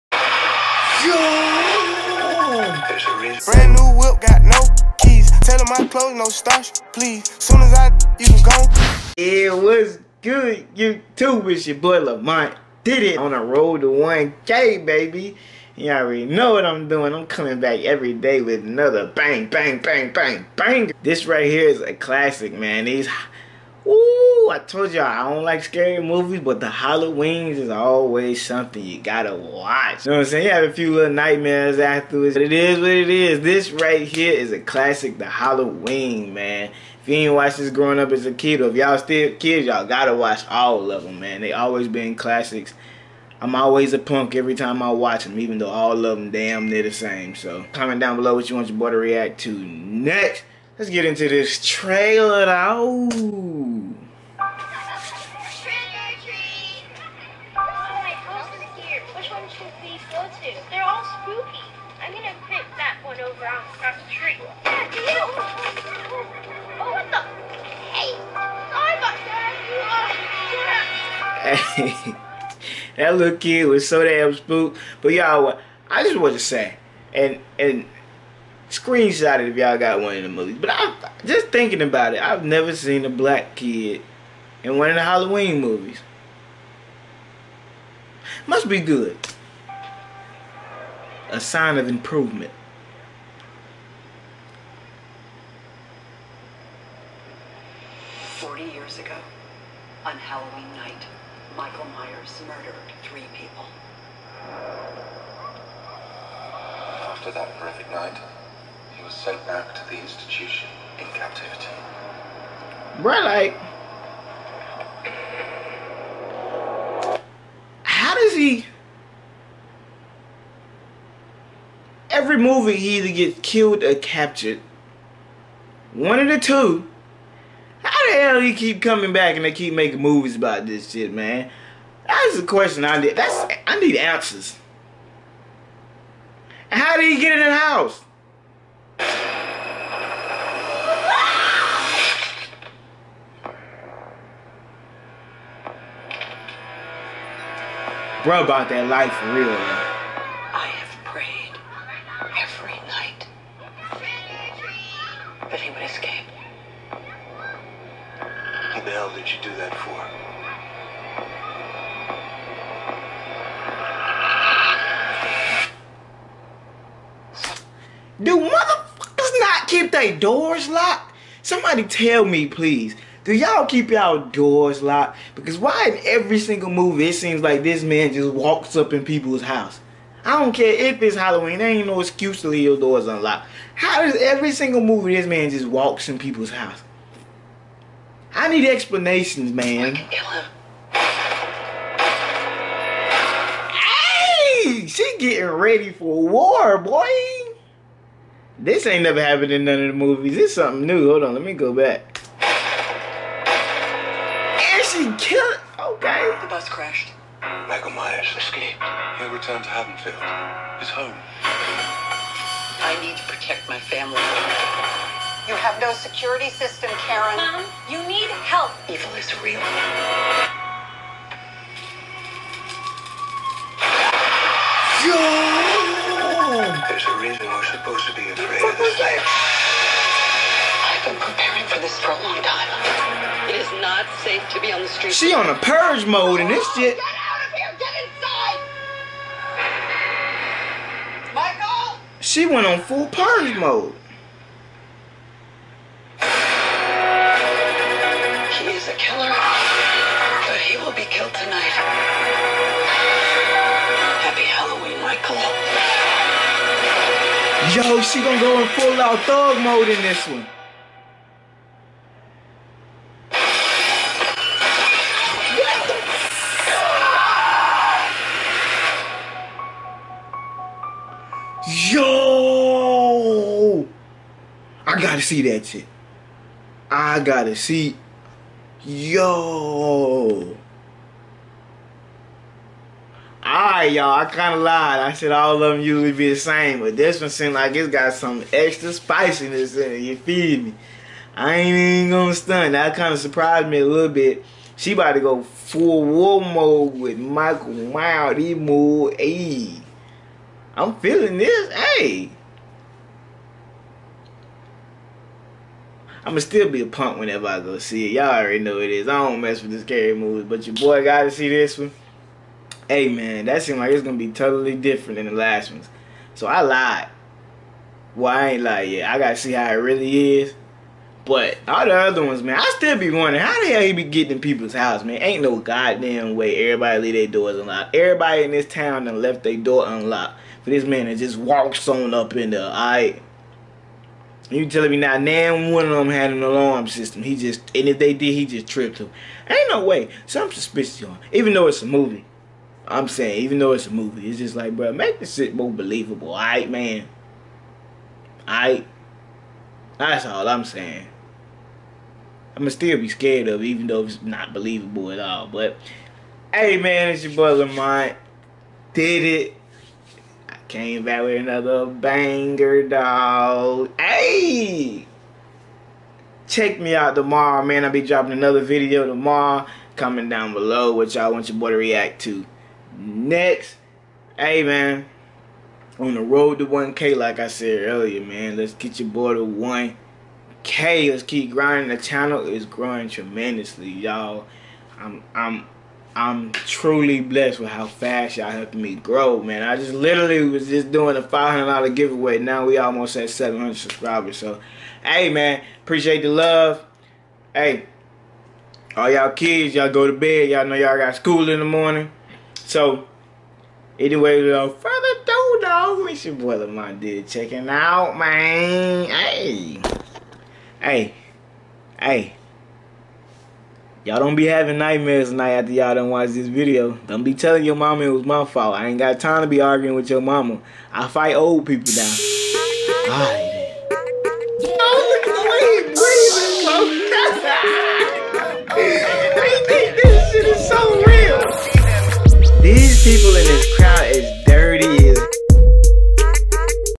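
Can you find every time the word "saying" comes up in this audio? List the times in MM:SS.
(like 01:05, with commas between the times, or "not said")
00:30, 05:43, 05:50.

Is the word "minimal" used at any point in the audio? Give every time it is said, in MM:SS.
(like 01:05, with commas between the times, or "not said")
not said.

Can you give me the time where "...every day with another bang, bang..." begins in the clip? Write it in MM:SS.
00:17.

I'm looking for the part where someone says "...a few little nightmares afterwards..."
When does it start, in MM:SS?
00:30.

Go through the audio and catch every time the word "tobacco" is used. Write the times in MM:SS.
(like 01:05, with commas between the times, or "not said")
not said.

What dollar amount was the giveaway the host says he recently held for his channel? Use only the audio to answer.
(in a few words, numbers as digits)
$500.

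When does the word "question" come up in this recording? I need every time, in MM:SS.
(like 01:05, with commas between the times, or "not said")
02:12.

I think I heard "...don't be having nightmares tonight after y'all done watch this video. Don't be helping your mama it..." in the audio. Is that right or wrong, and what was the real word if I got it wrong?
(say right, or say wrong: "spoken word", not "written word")
wrong: "telling", not "helping".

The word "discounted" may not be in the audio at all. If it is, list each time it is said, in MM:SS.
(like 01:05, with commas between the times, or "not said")
not said.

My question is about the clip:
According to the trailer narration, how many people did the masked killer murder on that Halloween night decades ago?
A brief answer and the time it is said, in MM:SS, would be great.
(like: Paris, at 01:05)
3, at 01:43.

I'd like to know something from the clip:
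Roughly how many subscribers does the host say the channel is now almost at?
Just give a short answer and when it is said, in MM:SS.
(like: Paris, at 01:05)
700, at 06:33.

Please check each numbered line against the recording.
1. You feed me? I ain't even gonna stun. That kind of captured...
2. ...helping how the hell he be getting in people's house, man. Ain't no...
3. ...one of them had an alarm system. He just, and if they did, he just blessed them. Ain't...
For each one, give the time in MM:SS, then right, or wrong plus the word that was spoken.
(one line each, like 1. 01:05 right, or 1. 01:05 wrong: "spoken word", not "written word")
1. 04:50 wrong: "surprised", not "captured"
2. 05:23 wrong: "wondering", not "helping"
3. 05:35 wrong: "tripped", not "blessed".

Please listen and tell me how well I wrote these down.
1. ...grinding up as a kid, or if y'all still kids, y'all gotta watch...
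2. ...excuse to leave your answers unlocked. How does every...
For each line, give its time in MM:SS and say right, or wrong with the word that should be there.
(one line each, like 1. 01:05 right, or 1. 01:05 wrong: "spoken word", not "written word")
1. 00:37 wrong: "growing", not "grinding"
2. 03:01 wrong: "doors", not "answers".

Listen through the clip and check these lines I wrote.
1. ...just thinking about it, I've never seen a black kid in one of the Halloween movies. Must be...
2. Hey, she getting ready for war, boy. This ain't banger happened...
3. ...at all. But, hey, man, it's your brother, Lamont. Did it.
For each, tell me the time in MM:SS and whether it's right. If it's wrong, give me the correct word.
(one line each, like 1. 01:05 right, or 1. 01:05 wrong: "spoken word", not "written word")
1. 01:21 right
2. 03:10 wrong: "never", not "banger"
3. 05:55 right.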